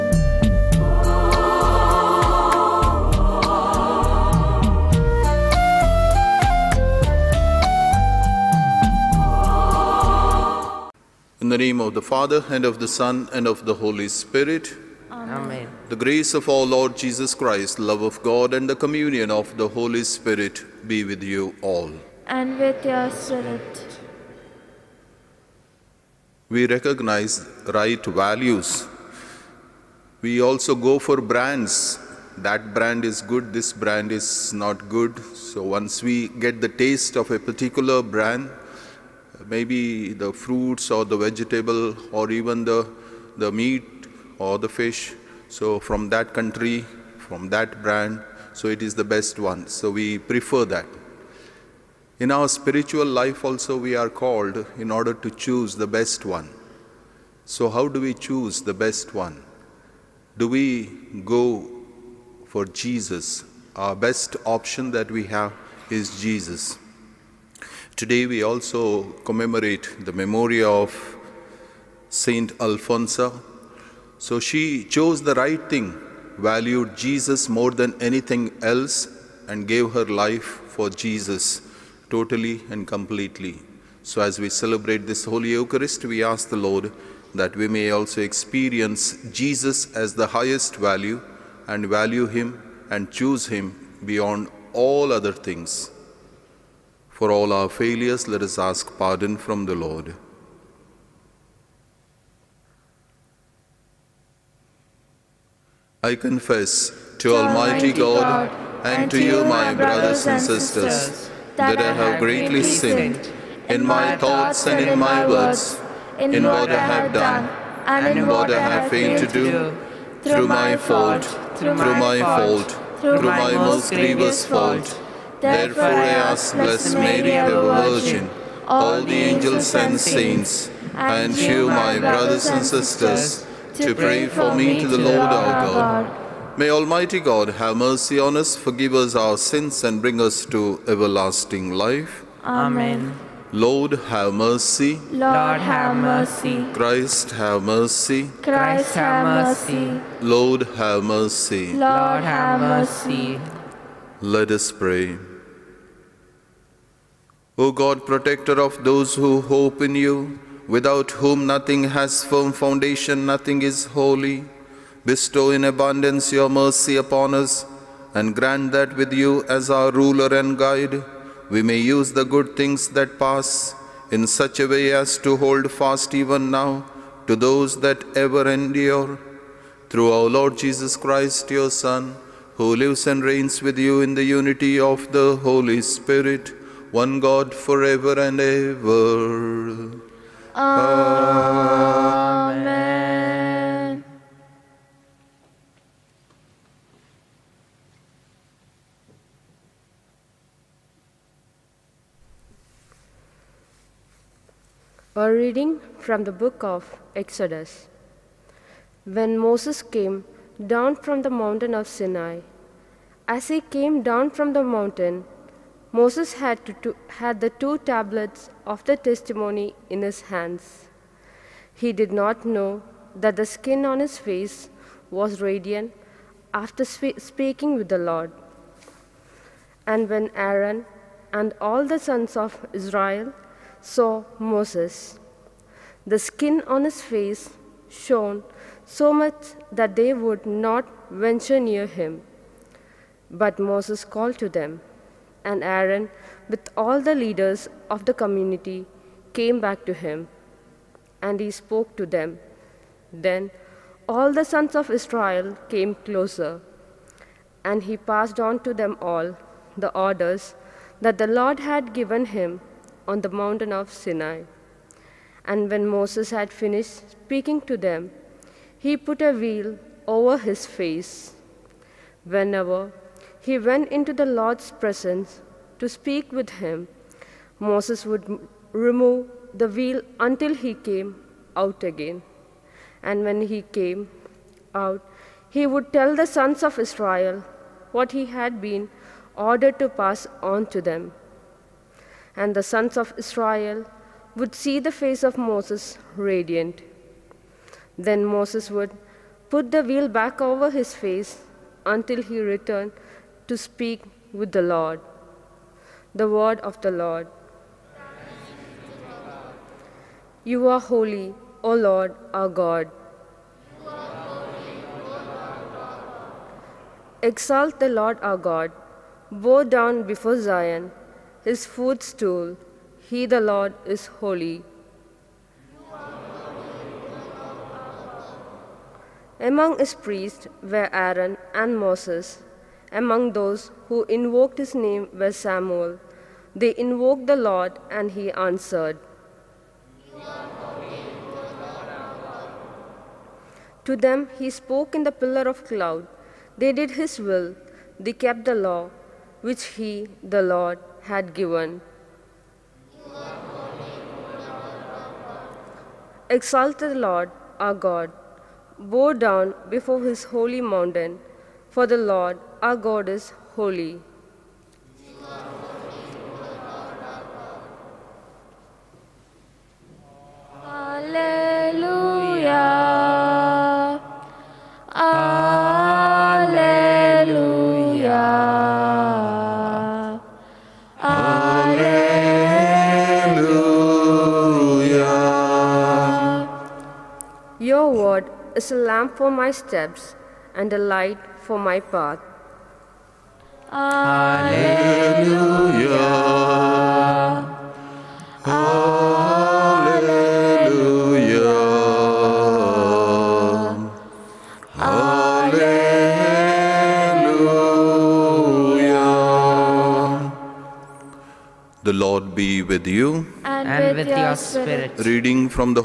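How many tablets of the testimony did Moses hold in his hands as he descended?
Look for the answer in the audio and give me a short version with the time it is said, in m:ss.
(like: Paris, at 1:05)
2, at 3:37.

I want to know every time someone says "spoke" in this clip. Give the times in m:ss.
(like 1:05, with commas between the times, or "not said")
4:11, 5:44.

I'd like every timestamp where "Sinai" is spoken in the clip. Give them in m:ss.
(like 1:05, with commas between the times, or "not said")
3:31, 4:23.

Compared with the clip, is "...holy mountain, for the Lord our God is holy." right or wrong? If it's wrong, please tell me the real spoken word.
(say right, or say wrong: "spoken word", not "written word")
right.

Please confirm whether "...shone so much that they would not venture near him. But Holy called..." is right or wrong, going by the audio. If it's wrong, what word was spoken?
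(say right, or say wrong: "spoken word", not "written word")
wrong: "Moses", not "Holy".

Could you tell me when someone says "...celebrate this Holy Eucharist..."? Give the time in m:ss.
1:24.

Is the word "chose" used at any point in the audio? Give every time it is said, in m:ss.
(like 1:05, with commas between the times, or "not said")
1:14.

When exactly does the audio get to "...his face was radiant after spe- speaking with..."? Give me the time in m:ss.
3:44.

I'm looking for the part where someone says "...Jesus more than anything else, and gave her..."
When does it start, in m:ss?
1:16.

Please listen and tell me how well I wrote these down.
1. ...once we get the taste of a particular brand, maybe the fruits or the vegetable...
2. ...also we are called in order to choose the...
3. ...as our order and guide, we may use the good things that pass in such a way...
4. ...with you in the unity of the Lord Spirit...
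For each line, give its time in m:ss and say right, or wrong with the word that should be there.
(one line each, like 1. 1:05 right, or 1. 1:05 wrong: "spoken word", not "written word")
1. 0:35 right
2. 0:53 right
3. 2:49 wrong: "ruler", not "order"
4. 3:03 wrong: "Holy", not "Lord".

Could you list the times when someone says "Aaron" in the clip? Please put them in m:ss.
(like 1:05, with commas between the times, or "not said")
3:50, 4:05, 5:30.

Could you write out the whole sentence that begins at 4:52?
And the sons of Israel would see the face of Moses radiant.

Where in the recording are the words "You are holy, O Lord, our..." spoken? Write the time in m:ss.
5:10.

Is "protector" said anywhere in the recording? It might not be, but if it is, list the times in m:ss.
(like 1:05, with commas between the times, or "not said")
2:38.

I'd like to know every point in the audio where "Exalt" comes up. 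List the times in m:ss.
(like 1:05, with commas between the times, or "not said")
5:17, 5:56.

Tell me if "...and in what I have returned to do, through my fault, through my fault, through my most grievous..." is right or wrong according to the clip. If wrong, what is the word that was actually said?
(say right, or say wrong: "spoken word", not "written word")
wrong: "failed", not "returned".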